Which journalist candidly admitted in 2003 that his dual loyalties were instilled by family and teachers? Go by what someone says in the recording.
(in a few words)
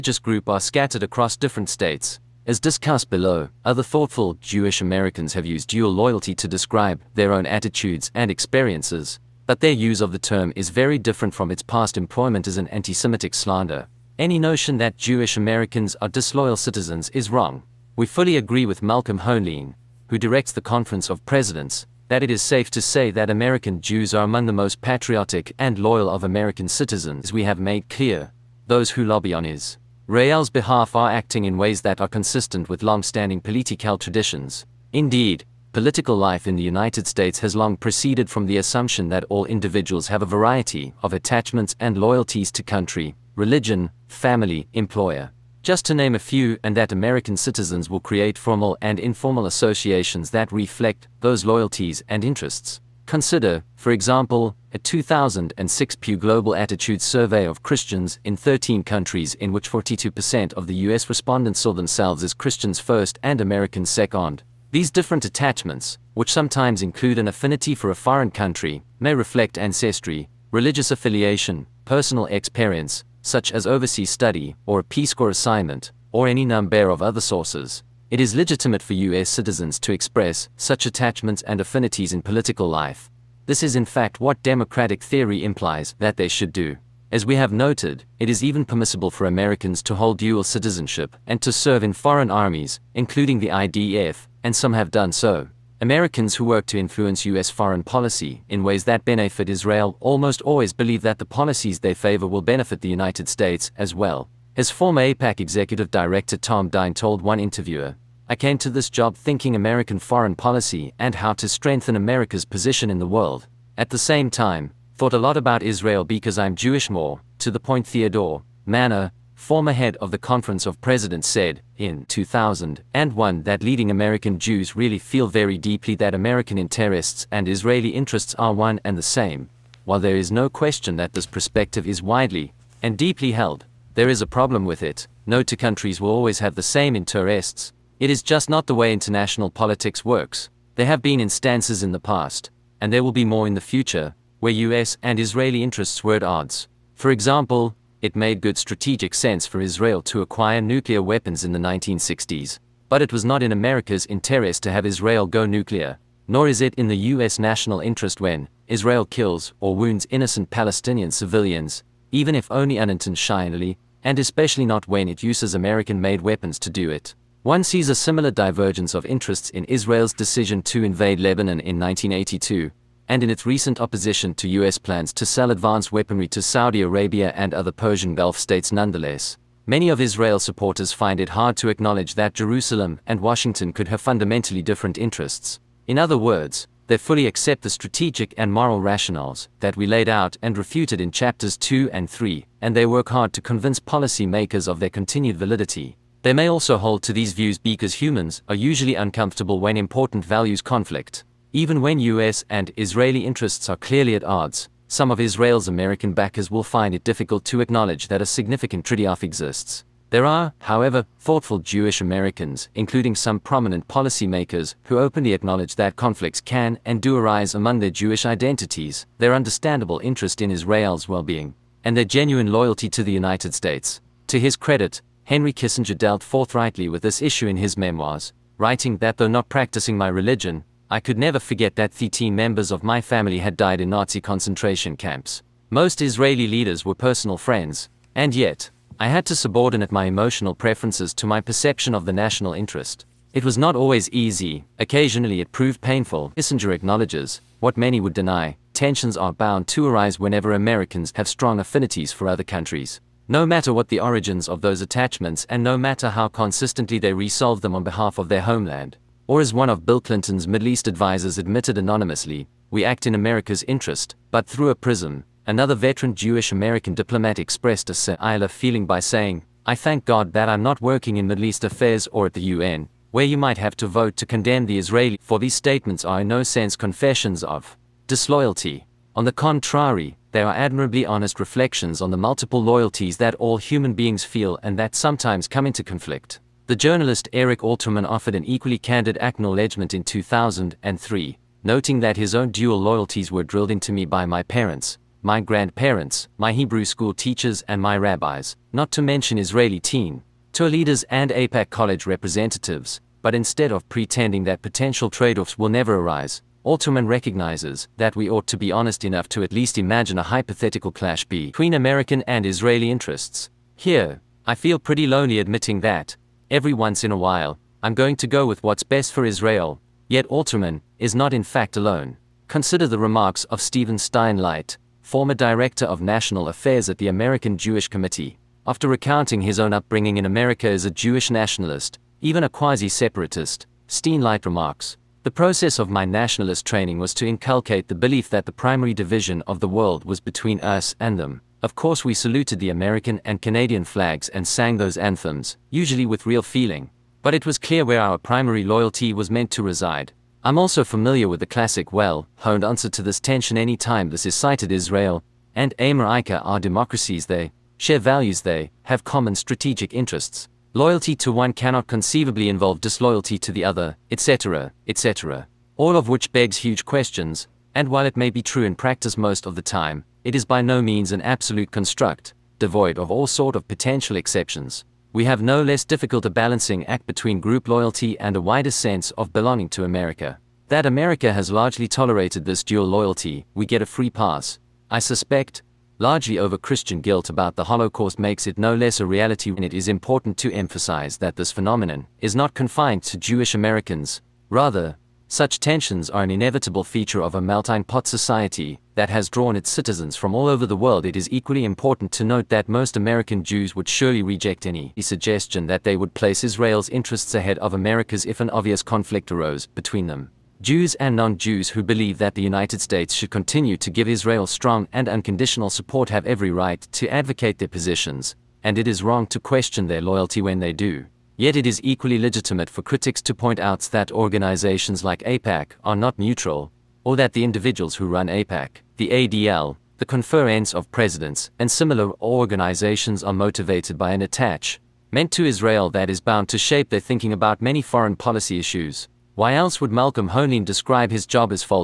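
Eric Alterman.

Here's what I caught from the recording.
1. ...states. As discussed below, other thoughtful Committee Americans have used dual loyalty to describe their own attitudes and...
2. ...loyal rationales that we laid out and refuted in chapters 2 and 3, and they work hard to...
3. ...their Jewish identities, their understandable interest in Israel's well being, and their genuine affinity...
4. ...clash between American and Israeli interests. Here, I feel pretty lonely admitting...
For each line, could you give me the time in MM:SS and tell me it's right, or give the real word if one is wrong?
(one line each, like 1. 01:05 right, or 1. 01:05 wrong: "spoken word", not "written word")
1. 00:01 wrong: "Jewish", not "Committee"
2. 03:08 wrong: "moral", not "loyal"
3. 03:37 wrong: "loyalty", not "affinity"
4. 05:10 right.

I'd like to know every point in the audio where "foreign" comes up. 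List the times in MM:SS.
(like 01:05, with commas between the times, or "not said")
01:07, 01:31, 01:37, 01:49, 07:17.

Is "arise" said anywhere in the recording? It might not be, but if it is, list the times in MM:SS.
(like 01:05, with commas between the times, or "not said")
03:37, 04:09, 05:05.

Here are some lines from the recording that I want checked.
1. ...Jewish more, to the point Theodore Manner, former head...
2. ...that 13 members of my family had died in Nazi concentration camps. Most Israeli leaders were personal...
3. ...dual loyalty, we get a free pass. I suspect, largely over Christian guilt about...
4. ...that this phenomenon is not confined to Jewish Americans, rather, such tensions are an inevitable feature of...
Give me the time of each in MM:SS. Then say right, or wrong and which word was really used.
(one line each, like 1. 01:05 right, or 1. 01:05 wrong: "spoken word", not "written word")
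1. 01:56 right
2. 03:51 right
3. 06:22 right
4. 06:31 right.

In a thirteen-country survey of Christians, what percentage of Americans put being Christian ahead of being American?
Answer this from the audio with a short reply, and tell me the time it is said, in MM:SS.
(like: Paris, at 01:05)
42%, at 00:59.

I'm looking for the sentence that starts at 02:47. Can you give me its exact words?
One sees a similar divergence of interests in Israel's decision to invade Lebanon in 1982, and in its recent opposition to U.S.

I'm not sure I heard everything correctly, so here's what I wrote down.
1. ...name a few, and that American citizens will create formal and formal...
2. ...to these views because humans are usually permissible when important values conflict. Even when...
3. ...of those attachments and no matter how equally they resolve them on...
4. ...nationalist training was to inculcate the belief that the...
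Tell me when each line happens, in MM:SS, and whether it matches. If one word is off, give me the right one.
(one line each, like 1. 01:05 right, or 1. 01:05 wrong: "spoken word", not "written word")
1. 00:45 wrong: "informal", not "formal"
2. 03:17 wrong: "uncomfortable", not "permissible"
3. 04:14 wrong: "consistently", not "equally"
4. 05:36 right.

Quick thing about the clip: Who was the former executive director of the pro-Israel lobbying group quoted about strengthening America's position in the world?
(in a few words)
Tom Dine.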